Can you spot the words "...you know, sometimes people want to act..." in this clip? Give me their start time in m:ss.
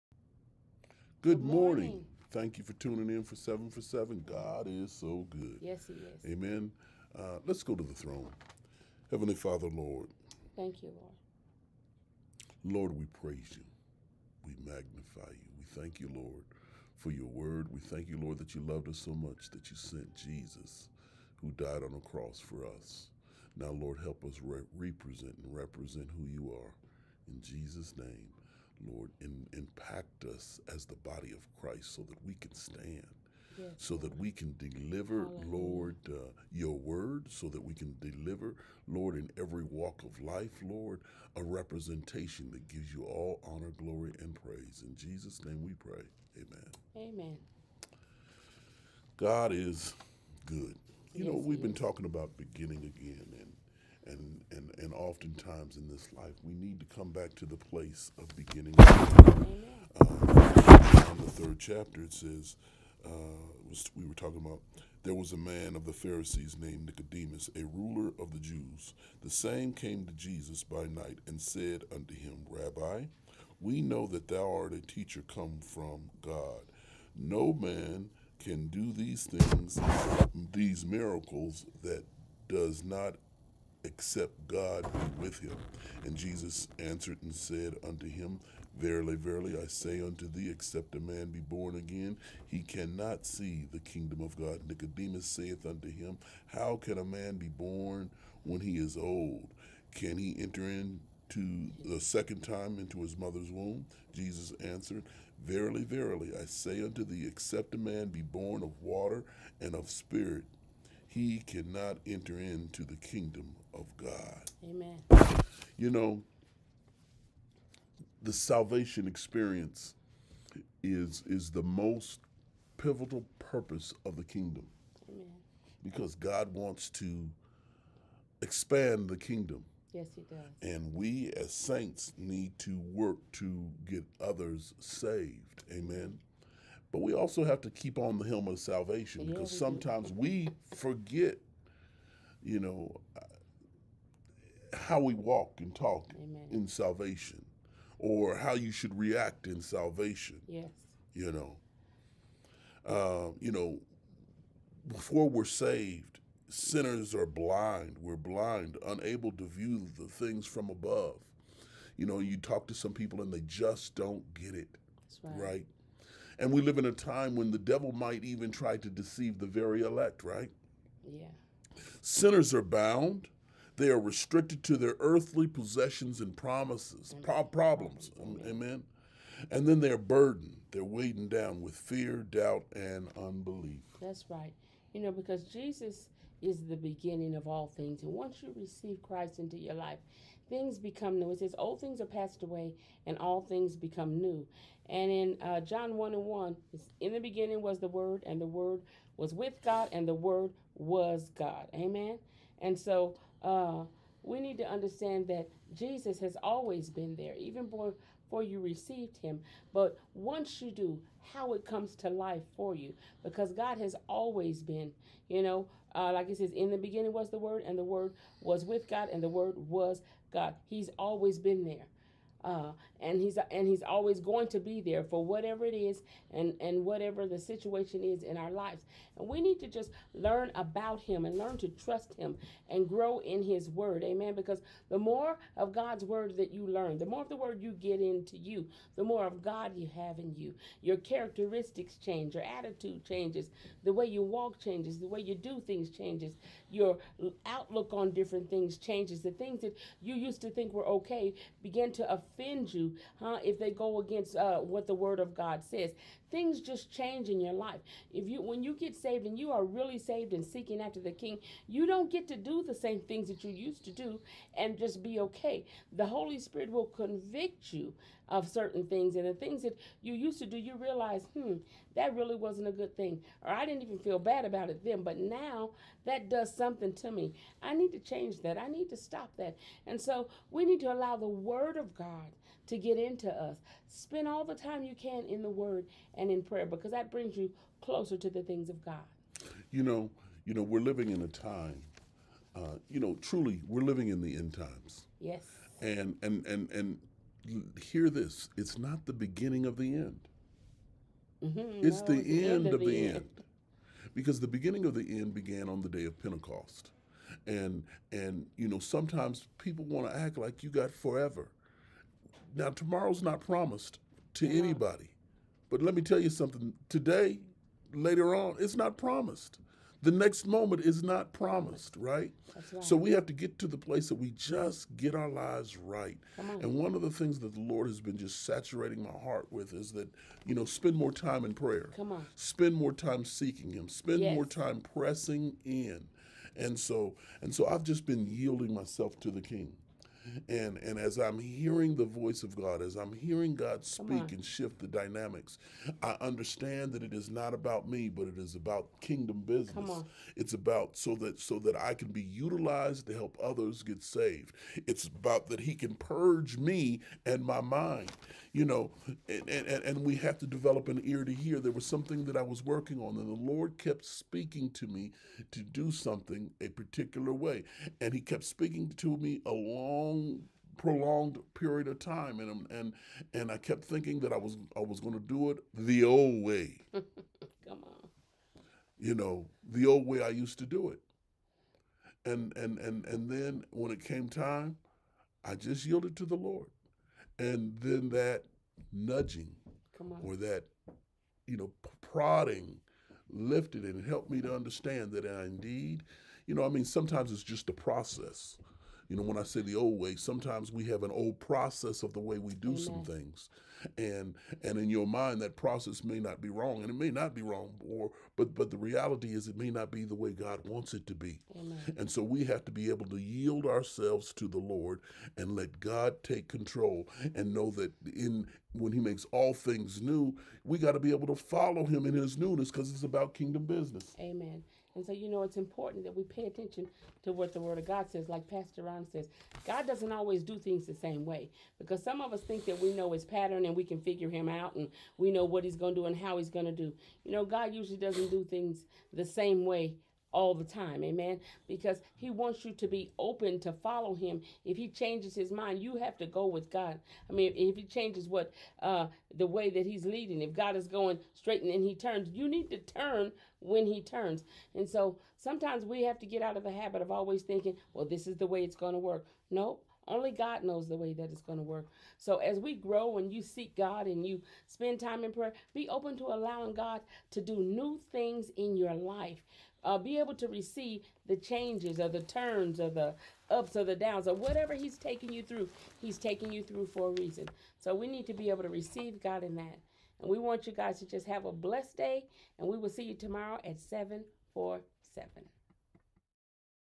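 5:08.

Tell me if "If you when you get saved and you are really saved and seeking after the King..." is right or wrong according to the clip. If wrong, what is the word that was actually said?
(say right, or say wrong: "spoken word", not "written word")
right.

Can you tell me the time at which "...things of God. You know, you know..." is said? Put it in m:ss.
4:48.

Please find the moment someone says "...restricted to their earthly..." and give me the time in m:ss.
2:53.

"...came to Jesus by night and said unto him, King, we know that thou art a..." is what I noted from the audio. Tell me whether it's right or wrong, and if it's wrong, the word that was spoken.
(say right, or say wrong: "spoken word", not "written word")
wrong: "Rabbi", not "King".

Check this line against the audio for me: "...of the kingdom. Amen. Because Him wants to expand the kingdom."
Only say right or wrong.
wrong.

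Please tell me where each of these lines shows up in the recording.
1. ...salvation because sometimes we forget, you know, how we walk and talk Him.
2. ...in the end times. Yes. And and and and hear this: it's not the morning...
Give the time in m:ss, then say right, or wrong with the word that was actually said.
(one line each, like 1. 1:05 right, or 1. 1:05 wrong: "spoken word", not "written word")
1. 2:18 wrong: "Amen", not "Him"
2. 4:54 wrong: "beginning", not "morning".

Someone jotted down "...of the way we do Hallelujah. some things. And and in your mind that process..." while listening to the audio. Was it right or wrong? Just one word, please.
wrong.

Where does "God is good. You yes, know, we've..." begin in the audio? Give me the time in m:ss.
0:49.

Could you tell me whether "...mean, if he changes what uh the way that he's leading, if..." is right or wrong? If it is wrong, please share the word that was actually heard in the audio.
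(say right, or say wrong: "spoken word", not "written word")
right.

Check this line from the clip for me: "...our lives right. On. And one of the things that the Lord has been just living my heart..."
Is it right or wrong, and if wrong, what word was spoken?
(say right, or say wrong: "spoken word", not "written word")
wrong: "saturating", not "living".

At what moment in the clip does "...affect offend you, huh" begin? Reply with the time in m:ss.
4:12.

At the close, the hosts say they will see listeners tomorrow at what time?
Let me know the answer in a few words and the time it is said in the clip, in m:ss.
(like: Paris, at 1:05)
7:47, at 8:03.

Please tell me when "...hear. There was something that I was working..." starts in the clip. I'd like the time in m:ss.
6:01.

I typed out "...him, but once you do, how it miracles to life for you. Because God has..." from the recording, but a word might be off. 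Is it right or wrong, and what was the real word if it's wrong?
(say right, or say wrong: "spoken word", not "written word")
wrong: "comes", not "miracles".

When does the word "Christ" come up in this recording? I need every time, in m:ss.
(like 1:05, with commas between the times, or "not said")
0:31, 3:09.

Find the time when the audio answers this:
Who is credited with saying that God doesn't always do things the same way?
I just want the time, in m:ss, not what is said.
7:08.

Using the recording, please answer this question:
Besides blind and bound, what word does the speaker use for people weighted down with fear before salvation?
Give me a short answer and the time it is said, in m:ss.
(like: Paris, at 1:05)
Burdened, at 2:59.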